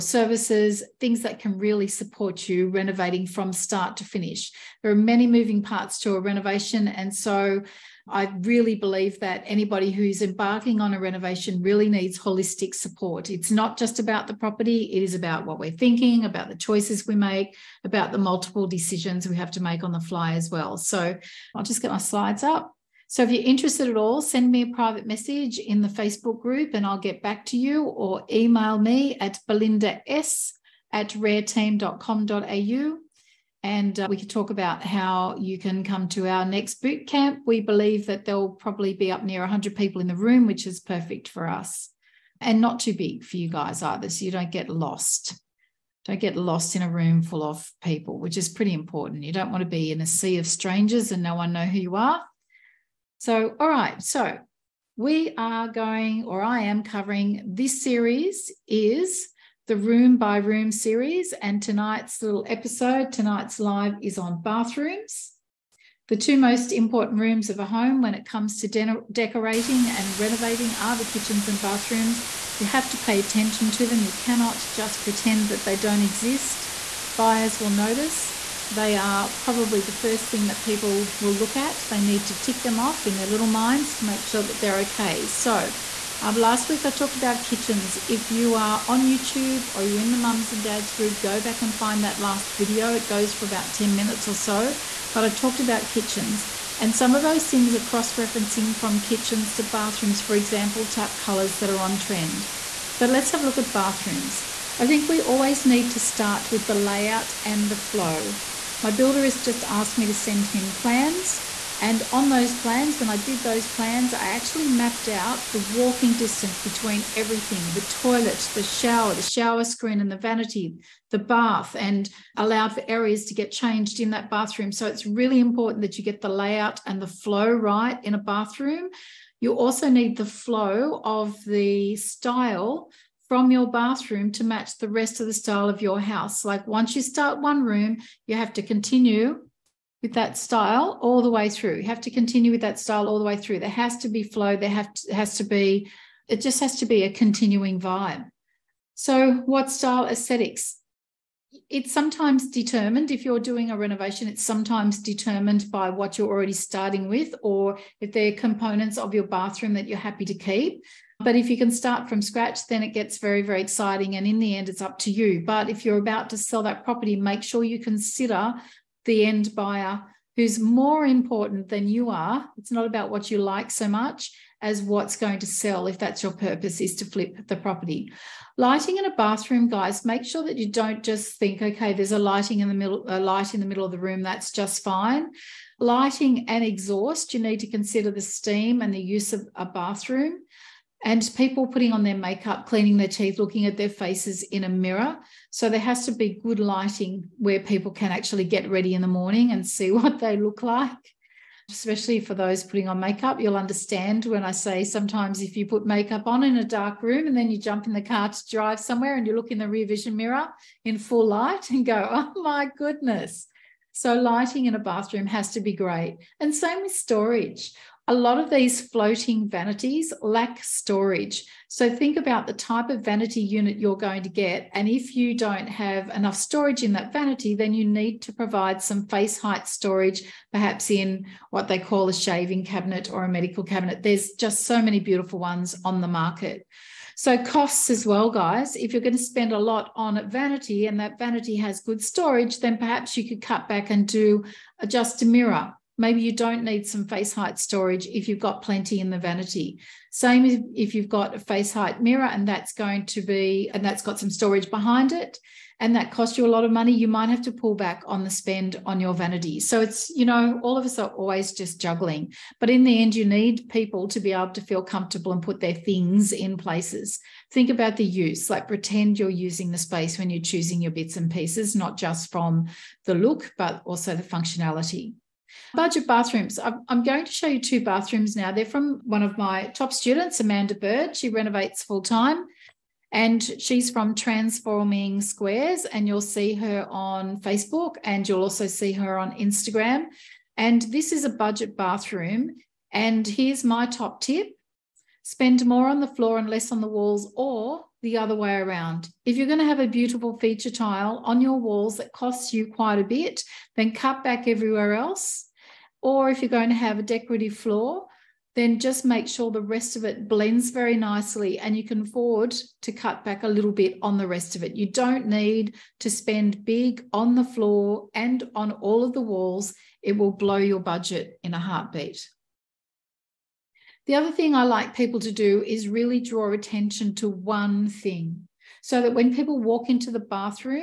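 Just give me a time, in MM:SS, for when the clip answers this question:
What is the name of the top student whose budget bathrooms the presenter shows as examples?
04:40.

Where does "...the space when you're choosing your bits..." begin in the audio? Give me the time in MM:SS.
04:29.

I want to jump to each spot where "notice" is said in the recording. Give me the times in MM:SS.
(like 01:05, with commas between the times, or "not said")
01:17.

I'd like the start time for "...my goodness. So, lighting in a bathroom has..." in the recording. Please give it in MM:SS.
03:32.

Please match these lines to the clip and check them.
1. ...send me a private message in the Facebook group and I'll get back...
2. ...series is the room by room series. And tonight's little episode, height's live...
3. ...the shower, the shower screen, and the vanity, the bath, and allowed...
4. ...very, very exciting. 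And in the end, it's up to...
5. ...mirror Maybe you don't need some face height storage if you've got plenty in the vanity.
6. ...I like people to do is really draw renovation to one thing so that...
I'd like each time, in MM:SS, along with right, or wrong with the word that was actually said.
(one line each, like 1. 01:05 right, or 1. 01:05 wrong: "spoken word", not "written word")
1. 00:24 right
2. 00:57 wrong: "tonight", not "height"
3. 01:58 right
4. 02:43 right
5. 04:05 right
6. 05:24 wrong: "attention", not "renovation".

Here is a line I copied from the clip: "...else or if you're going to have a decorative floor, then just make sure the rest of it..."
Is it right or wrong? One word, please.
right.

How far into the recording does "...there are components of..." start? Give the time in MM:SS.
02:38.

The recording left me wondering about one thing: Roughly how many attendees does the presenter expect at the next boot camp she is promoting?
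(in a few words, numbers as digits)
100.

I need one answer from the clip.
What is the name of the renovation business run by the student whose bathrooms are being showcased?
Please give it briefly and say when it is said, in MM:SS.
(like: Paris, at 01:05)
Transforming Squares, at 04:44.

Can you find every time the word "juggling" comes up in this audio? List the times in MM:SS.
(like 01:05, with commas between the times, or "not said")
04:21.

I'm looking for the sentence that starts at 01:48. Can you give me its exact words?
My builder has just asked me to send him plans.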